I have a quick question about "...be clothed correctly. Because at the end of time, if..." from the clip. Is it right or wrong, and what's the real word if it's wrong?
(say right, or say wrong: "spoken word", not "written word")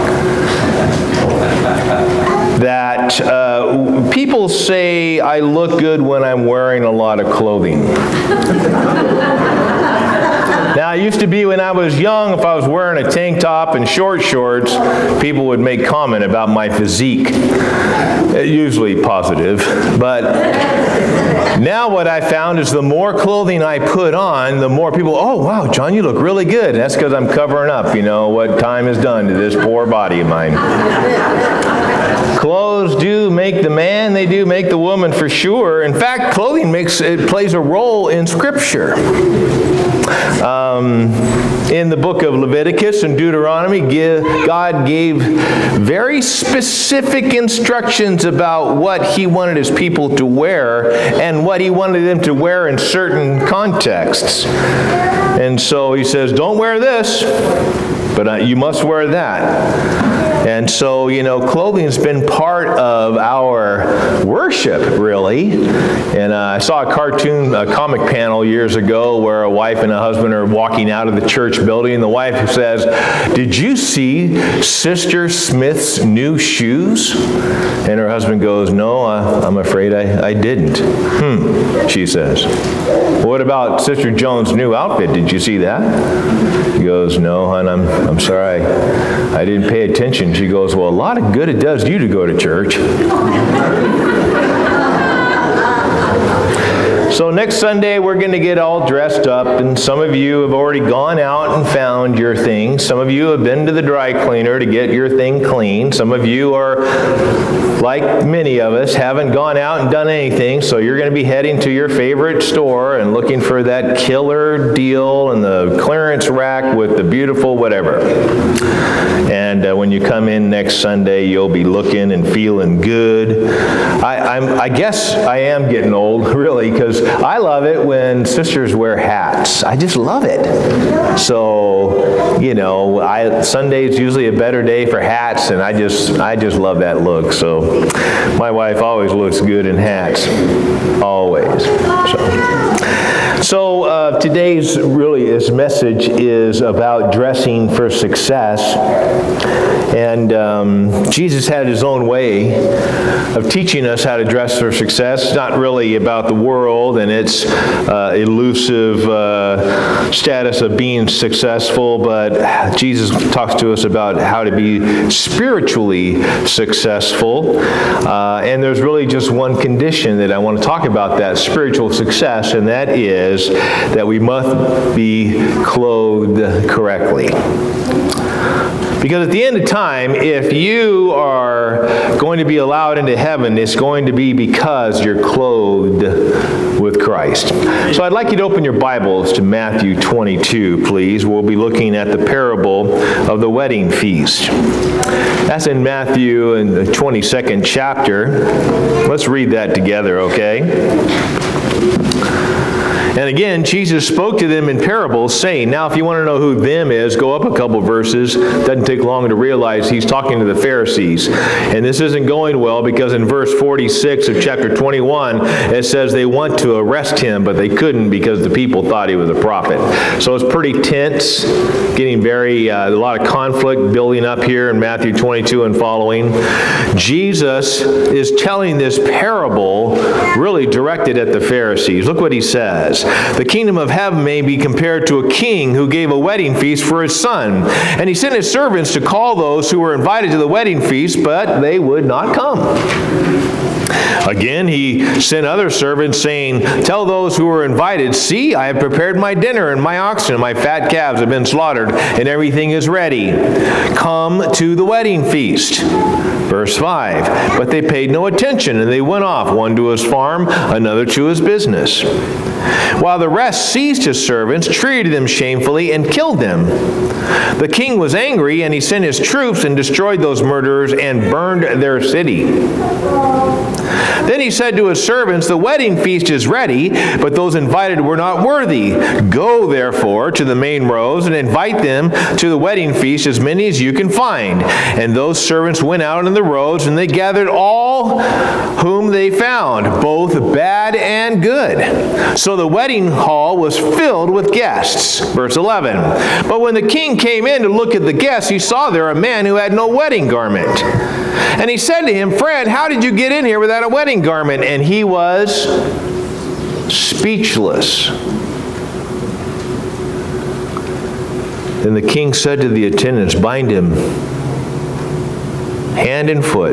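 right.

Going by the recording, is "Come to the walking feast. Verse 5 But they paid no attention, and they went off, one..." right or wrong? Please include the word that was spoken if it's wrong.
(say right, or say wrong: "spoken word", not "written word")
wrong: "wedding", not "walking".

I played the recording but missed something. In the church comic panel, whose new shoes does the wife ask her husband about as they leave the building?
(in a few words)
Sister Smith.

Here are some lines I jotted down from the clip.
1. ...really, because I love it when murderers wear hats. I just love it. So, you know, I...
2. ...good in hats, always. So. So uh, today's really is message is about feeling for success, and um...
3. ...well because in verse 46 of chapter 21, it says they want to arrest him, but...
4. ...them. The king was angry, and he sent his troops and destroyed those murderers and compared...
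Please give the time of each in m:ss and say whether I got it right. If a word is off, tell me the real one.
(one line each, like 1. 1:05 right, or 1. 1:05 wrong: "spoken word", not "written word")
1. 2:06 wrong: "sisters", not "murderers"
2. 2:19 wrong: "dressing", not "feeling"
3. 3:32 right
4. 4:26 wrong: "burned", not "compared".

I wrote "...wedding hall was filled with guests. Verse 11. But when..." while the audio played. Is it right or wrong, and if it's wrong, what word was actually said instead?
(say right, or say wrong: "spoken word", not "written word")
right.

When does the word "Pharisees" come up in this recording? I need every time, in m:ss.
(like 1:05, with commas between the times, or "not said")
3:30, 3:51.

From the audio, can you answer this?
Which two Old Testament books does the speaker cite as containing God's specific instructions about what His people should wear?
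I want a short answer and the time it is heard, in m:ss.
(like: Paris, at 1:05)
Leviticus and Deuteronomy, at 0:42.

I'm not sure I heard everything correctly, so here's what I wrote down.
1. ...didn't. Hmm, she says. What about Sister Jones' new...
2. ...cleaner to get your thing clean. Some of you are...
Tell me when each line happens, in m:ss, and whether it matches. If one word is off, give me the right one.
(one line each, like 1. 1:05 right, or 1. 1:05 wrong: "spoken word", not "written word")
1. 1:20 right
2. 1:44 right.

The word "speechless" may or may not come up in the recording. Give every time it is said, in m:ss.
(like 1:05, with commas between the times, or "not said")
5:06.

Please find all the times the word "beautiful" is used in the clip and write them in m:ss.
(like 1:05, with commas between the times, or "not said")
1:57.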